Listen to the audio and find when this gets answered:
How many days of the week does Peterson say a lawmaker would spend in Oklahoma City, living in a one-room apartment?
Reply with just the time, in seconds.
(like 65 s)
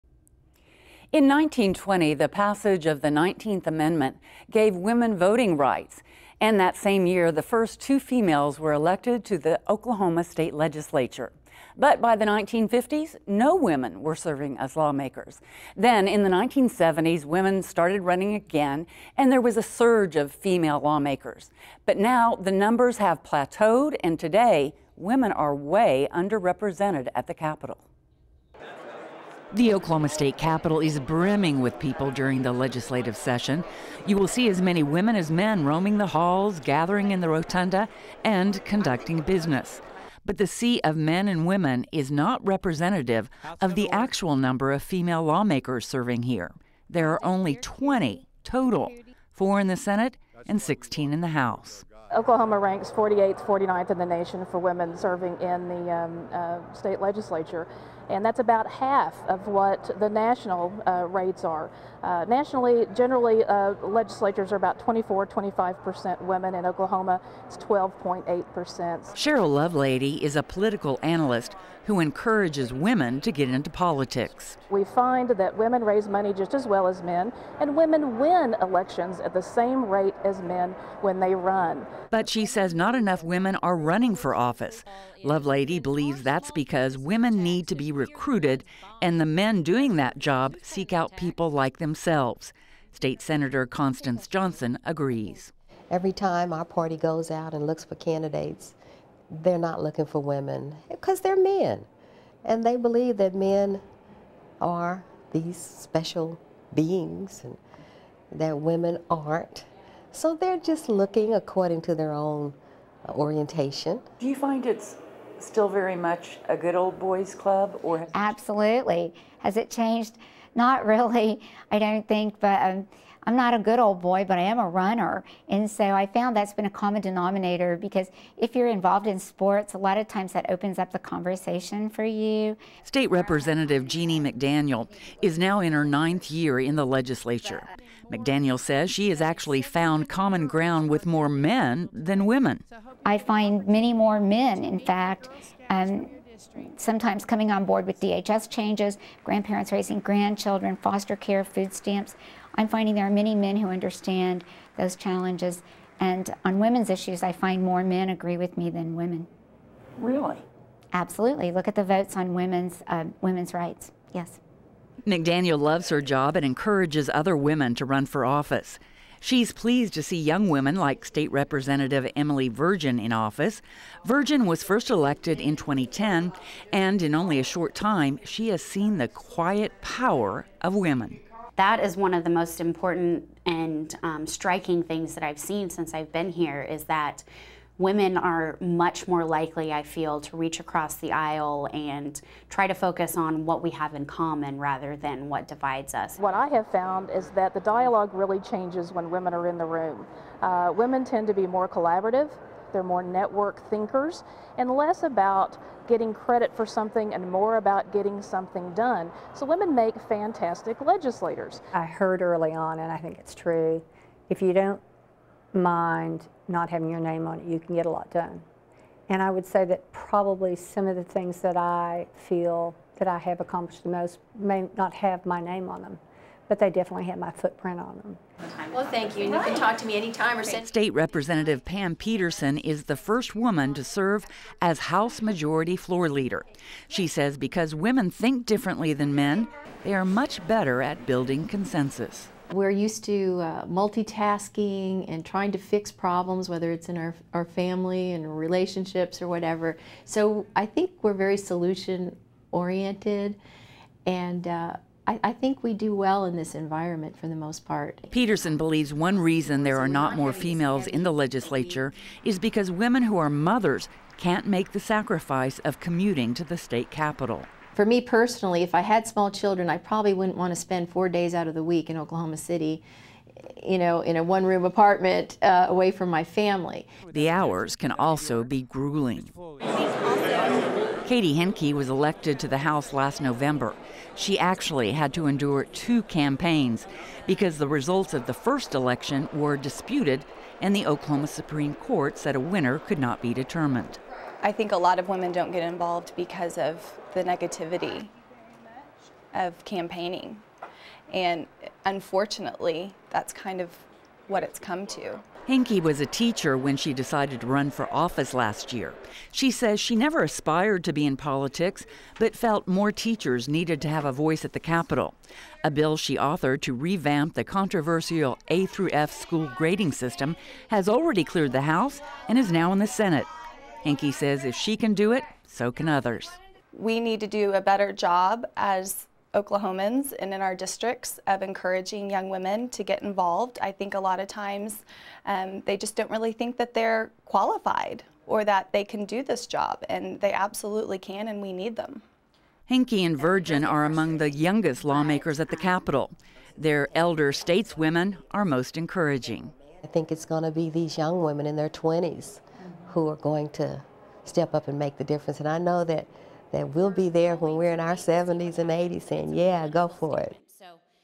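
270 s.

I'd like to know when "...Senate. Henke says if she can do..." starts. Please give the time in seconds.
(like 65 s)
322 s.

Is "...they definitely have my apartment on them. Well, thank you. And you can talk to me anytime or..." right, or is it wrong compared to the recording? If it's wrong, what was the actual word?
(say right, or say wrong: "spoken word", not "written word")
wrong: "footprint", not "apartment".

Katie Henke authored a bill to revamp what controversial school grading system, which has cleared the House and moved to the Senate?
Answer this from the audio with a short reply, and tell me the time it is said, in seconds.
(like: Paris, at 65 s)
A through F, at 318 s.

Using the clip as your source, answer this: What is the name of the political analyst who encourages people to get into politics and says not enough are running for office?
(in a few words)
Sheryl Lovelady.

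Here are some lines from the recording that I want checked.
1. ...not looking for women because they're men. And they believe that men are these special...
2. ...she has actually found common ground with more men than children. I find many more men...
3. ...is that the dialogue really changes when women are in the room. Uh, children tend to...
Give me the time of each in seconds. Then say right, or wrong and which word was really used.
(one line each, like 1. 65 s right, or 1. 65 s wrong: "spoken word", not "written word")
1. 99 s right
2. 138 s wrong: "women", not "children"
3. 197 s wrong: "women", not "children".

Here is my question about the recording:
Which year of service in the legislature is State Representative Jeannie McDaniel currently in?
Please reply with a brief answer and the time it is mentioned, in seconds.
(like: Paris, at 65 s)
ninth year, at 135 s.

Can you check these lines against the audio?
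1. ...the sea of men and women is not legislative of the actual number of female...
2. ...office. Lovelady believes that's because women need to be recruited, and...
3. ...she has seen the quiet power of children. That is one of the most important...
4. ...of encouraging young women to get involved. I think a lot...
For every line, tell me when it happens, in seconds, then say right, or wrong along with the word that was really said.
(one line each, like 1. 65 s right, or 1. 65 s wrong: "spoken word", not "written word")
1. 40 s wrong: "representative", not "legislative"
2. 84 s right
3. 178 s wrong: "women", not "children"
4. 331 s right.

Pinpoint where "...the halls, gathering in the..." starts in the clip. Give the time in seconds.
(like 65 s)
35 s.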